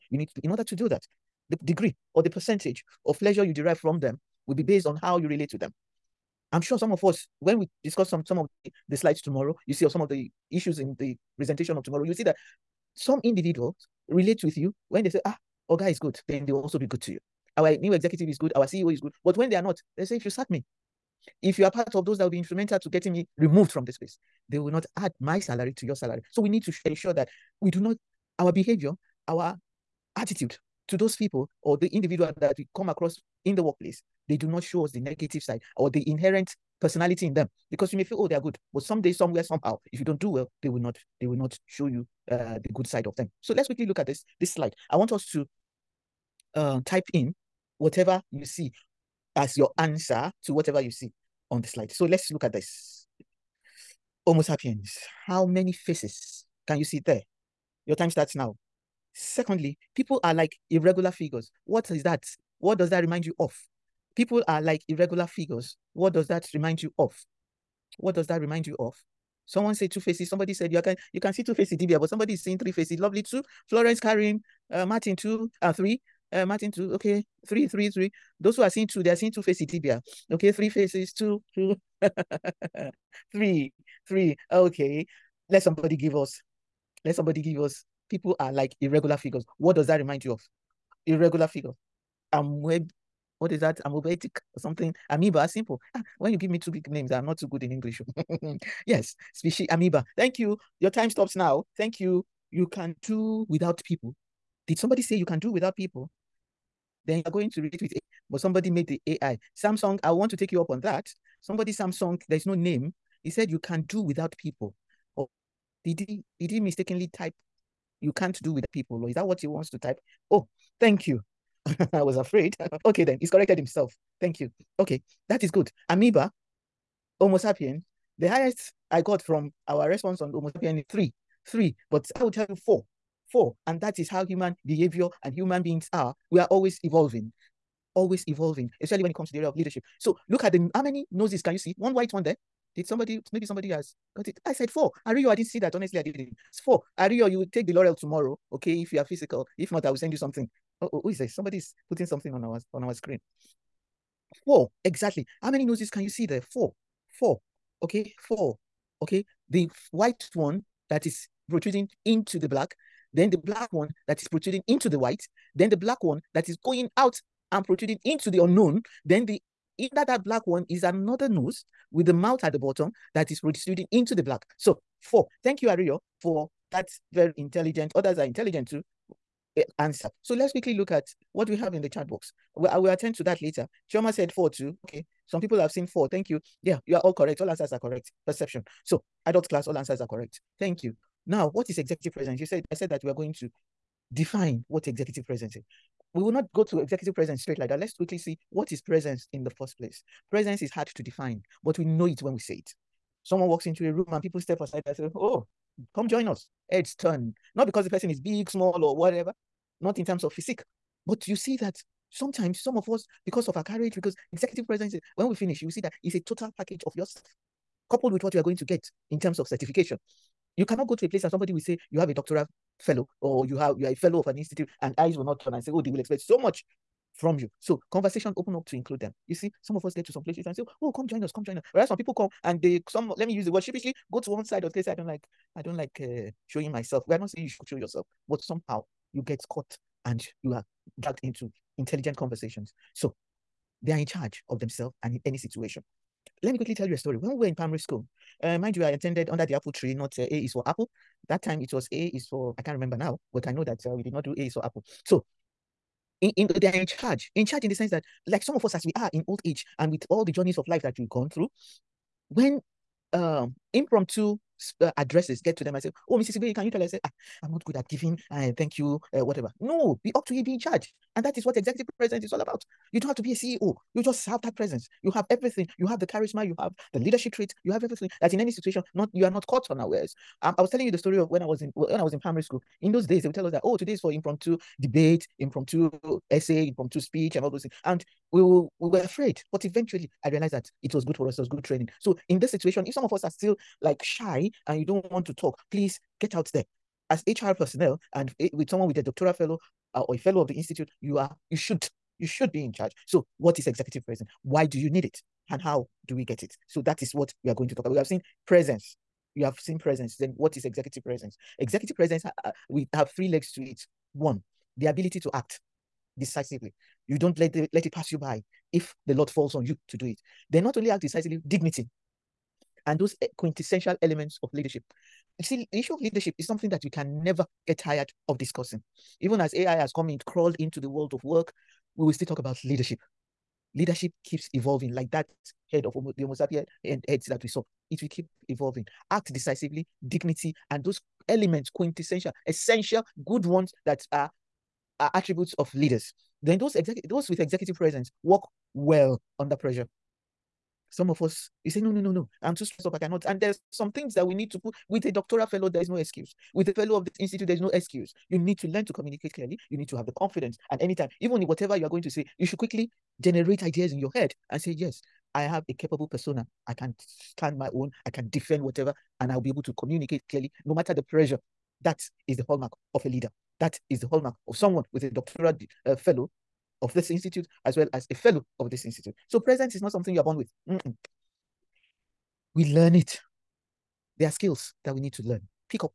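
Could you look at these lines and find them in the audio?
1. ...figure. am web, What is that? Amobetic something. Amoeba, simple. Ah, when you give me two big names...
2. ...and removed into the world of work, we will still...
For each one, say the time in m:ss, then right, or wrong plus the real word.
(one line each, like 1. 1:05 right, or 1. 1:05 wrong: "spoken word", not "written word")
1. 1:31 right
2. 5:30 wrong: "crawled", not "removed".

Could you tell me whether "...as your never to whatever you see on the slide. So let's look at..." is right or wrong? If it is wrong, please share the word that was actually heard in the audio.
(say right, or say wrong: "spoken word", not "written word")
wrong: "answer", not "never".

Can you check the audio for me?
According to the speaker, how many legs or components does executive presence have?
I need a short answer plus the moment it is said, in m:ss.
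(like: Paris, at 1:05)
3, at 5:13.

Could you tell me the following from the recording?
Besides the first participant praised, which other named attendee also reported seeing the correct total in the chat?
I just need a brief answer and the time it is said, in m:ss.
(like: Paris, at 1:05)
Choma, at 3:03.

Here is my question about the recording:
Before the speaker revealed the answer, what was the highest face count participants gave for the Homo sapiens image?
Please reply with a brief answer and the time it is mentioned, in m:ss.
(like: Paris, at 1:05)
3, at 2:08.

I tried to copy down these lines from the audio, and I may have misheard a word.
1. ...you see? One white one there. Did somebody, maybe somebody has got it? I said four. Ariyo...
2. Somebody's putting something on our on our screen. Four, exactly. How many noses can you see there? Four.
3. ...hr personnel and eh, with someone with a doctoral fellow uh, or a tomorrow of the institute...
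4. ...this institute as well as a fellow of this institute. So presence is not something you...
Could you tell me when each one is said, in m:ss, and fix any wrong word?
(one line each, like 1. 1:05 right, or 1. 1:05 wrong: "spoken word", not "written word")
1. 2:21 right
2. 2:31 right
3. 4:57 wrong: "fellow", not "tomorrow"
4. 6:16 right.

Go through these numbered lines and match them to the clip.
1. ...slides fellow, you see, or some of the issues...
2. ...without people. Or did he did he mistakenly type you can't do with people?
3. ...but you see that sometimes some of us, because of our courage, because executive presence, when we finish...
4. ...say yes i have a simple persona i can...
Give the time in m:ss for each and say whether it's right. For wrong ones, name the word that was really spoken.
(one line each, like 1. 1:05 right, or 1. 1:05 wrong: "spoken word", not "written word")
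1. 0:08 wrong: "tomorrow", not "fellow"
2. 1:54 right
3. 3:31 right
4. 6:04 wrong: "capable", not "simple".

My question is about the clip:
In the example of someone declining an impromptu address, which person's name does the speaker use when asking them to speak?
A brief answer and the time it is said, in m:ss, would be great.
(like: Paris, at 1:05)
Mrs. Igbe, at 4:26.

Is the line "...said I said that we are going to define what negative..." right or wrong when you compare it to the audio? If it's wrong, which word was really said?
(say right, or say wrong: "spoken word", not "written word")
wrong: "executive", not "negative".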